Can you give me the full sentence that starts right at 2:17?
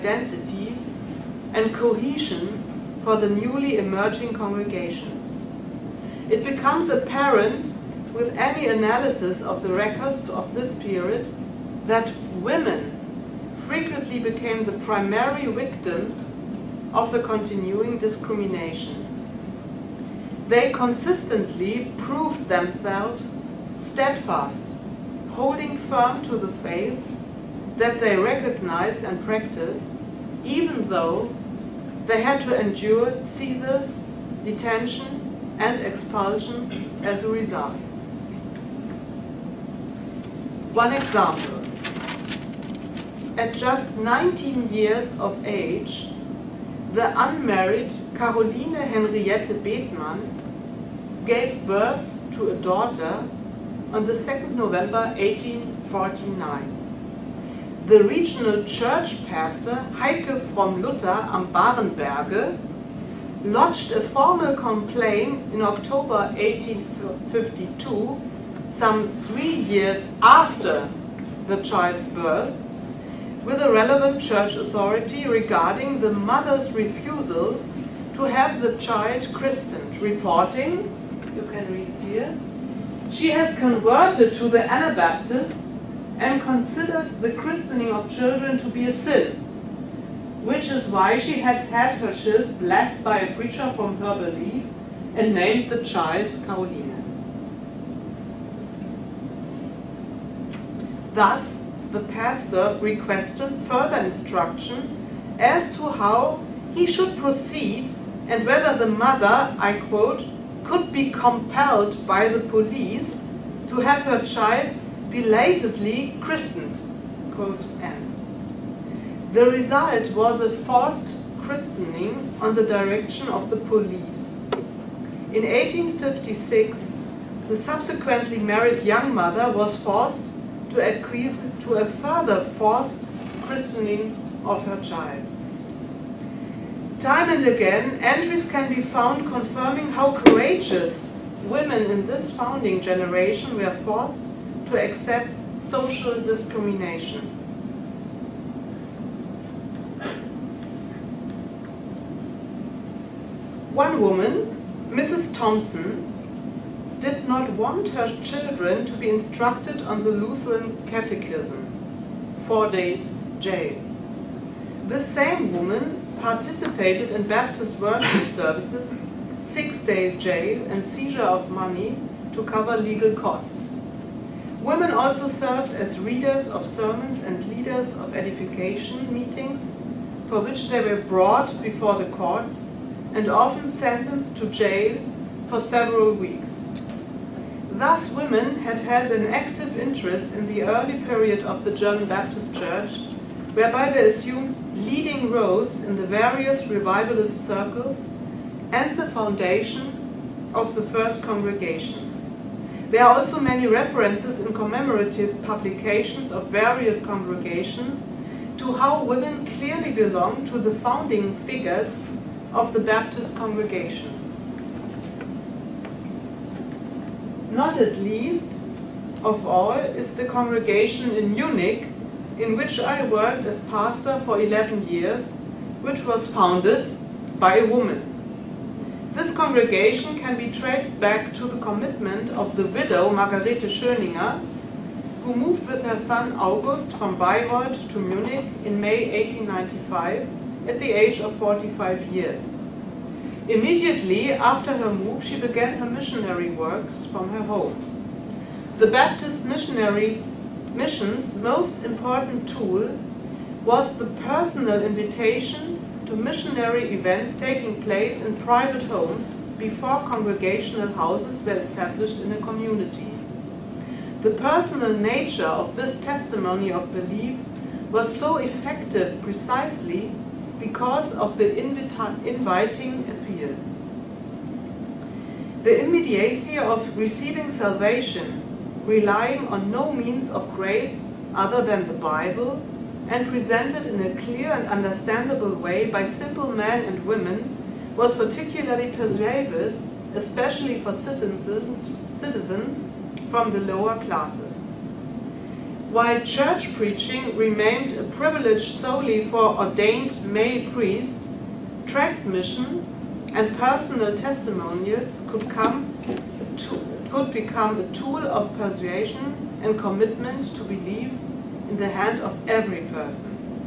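Time and again, entries can be found confirming how courageous women in this founding generation were forced to accept social discrimination.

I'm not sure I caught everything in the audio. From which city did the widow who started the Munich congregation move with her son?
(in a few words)
Bayreuth.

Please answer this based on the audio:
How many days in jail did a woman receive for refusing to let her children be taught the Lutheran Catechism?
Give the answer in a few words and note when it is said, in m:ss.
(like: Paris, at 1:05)
4, at 2:42.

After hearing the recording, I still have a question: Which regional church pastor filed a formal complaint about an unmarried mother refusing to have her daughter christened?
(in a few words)
Heike.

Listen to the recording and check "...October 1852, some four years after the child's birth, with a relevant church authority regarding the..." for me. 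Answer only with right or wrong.
wrong.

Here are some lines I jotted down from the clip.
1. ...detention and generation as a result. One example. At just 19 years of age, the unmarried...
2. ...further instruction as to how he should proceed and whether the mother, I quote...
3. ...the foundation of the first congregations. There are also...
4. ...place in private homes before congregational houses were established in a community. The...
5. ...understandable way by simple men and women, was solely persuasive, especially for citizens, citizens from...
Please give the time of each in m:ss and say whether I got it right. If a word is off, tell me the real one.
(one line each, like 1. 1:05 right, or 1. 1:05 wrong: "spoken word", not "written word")
1. 0:34 wrong: "expulsion", not "generation"
2. 1:43 right
3. 3:18 right
4. 4:17 right
5. 4:44 wrong: "particularly", not "solely".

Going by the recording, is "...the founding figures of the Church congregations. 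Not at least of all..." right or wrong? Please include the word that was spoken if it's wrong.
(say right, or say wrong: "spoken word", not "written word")
wrong: "Baptist", not "Church".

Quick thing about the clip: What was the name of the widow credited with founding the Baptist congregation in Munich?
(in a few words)
Margarete Schöninger.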